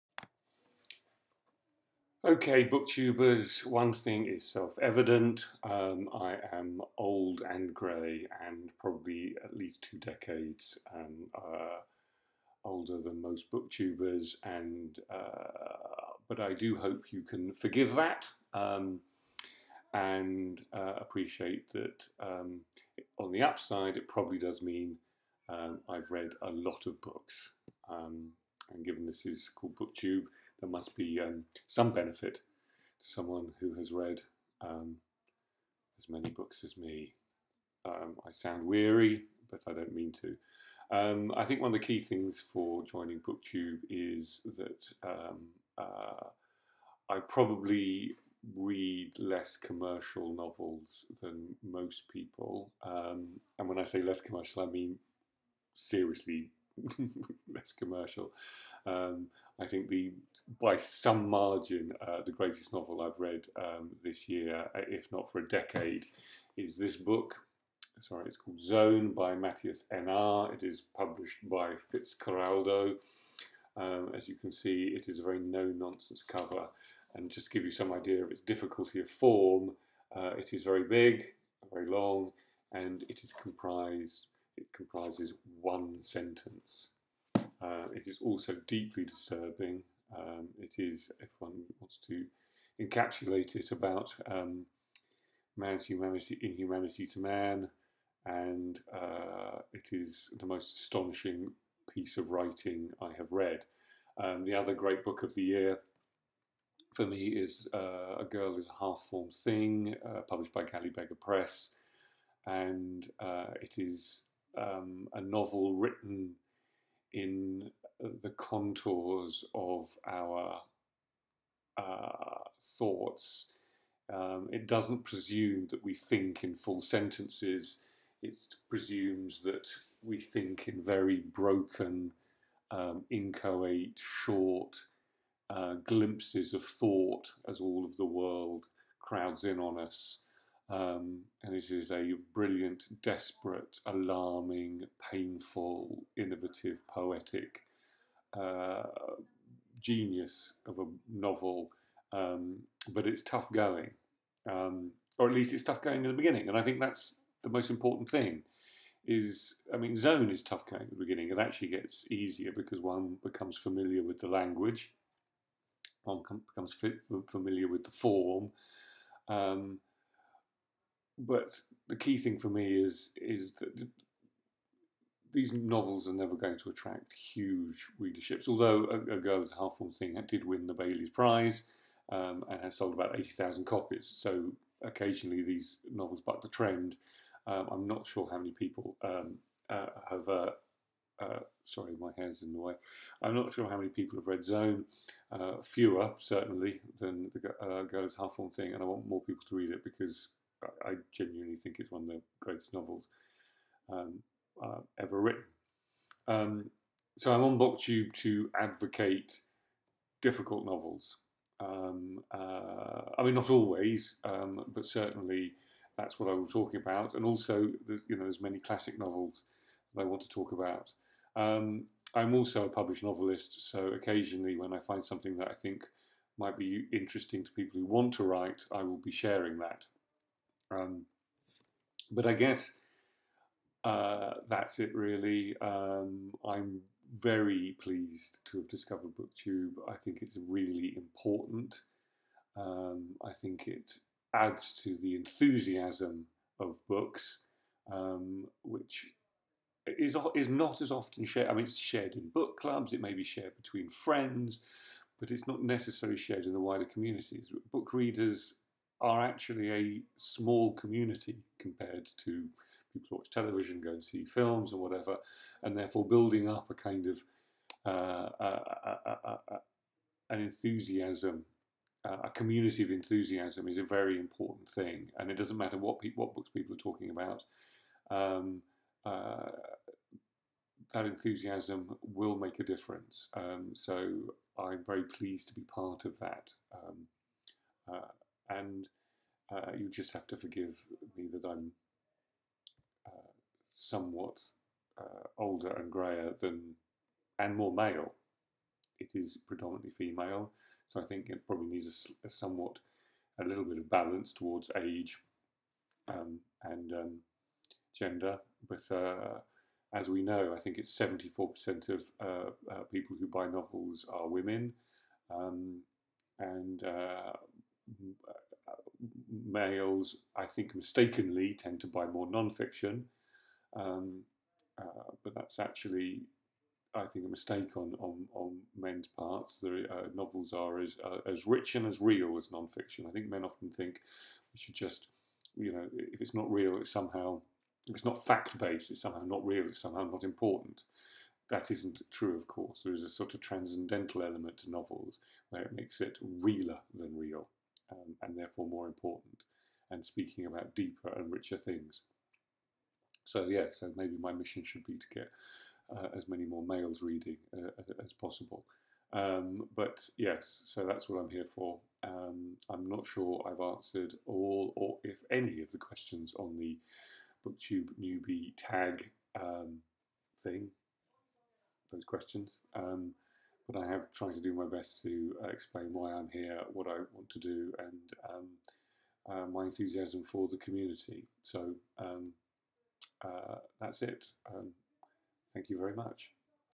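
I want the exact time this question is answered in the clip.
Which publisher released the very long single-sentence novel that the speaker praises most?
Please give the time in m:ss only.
1:11.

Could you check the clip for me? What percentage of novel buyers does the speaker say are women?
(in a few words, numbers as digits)
74%.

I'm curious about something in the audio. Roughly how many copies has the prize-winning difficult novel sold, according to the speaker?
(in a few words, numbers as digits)
80,000.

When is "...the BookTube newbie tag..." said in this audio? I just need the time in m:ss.
6:06.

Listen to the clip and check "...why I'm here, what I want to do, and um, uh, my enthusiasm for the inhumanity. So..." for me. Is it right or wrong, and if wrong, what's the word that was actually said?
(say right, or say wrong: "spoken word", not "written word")
wrong: "community", not "inhumanity".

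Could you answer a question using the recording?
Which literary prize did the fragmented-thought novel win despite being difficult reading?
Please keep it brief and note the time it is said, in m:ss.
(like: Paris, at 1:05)
Bailey's Prize, at 3:00.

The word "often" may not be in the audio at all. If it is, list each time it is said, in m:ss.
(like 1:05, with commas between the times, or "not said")
4:10, 5:33.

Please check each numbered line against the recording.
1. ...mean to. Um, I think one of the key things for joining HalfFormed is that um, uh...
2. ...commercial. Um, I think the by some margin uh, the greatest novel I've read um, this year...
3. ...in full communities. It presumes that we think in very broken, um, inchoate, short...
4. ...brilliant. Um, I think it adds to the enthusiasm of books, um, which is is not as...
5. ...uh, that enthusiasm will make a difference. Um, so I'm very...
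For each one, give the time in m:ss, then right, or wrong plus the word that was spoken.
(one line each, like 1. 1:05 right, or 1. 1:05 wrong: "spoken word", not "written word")
1. 0:39 wrong: "BookTube", not "HalfFormed"
2. 0:57 right
3. 2:06 wrong: "sentences", not "communities"
4. 4:00 wrong: "important", not "brilliant"
5. 4:39 right.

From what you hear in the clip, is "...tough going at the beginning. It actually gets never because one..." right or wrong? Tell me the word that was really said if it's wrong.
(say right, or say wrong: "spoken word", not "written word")
wrong: "easier", not "never".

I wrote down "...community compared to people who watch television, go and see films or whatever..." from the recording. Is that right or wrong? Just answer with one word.
right.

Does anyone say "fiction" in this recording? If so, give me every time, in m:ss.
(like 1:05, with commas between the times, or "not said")
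5:22, 5:32.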